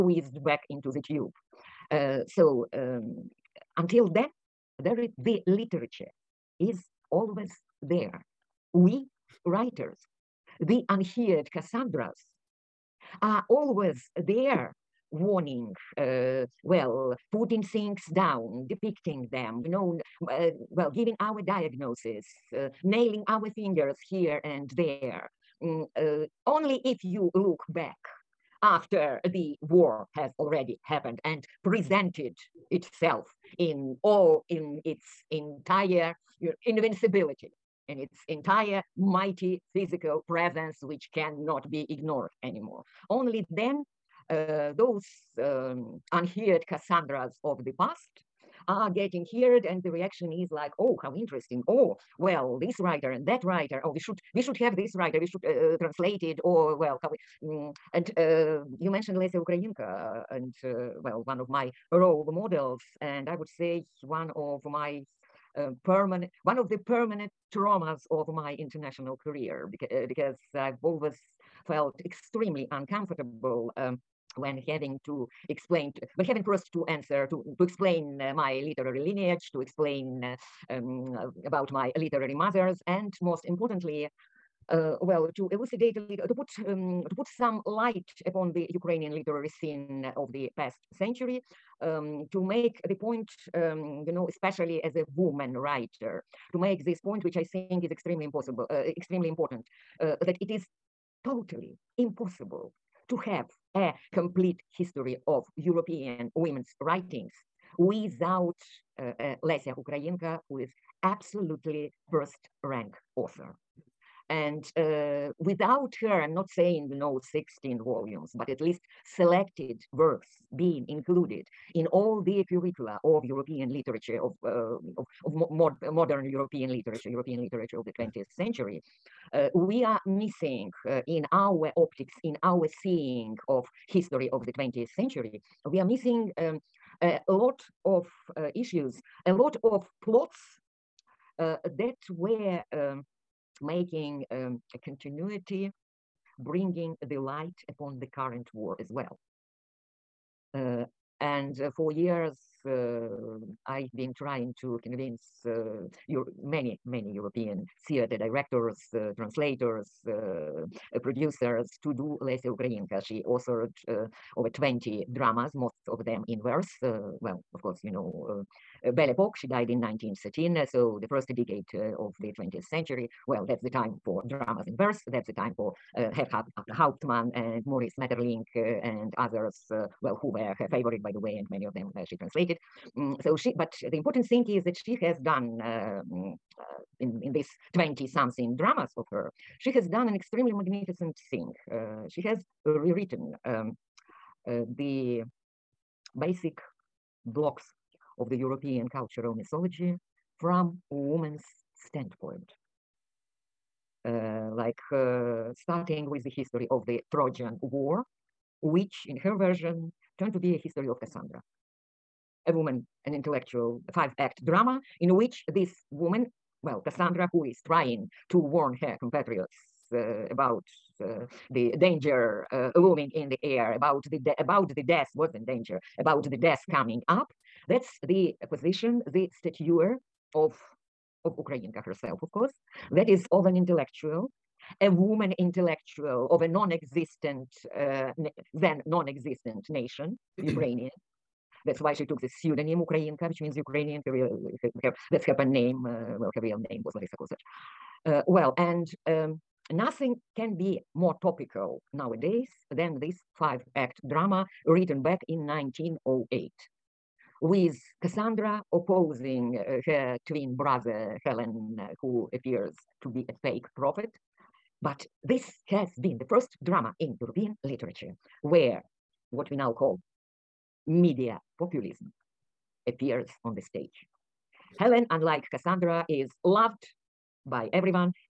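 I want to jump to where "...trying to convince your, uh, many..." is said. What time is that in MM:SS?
02:34.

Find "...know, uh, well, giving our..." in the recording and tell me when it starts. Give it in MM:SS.
00:19.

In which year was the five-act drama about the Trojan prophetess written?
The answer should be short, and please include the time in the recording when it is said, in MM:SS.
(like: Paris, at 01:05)
1908, at 04:15.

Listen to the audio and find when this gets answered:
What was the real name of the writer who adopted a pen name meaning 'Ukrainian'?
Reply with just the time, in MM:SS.
04:06.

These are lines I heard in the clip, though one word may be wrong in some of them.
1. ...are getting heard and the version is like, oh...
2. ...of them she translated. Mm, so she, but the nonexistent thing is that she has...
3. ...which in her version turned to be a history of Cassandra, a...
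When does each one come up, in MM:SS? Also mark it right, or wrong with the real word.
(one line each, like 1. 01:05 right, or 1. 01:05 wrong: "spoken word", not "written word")
1. 00:48 wrong: "reaction", not "version"
2. 03:01 wrong: "important", not "nonexistent"
3. 03:28 right.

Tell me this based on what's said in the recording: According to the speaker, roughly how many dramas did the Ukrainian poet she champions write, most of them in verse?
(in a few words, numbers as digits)
over 20.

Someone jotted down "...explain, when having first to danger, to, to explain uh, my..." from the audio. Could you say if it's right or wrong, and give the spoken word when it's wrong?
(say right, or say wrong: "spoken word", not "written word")
wrong: "answer", not "danger".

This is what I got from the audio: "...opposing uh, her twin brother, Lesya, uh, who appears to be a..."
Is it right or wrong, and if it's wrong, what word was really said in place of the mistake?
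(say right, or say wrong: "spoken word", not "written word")
wrong: "Helen", not "Lesya".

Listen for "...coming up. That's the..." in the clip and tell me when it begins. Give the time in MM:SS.
03:46.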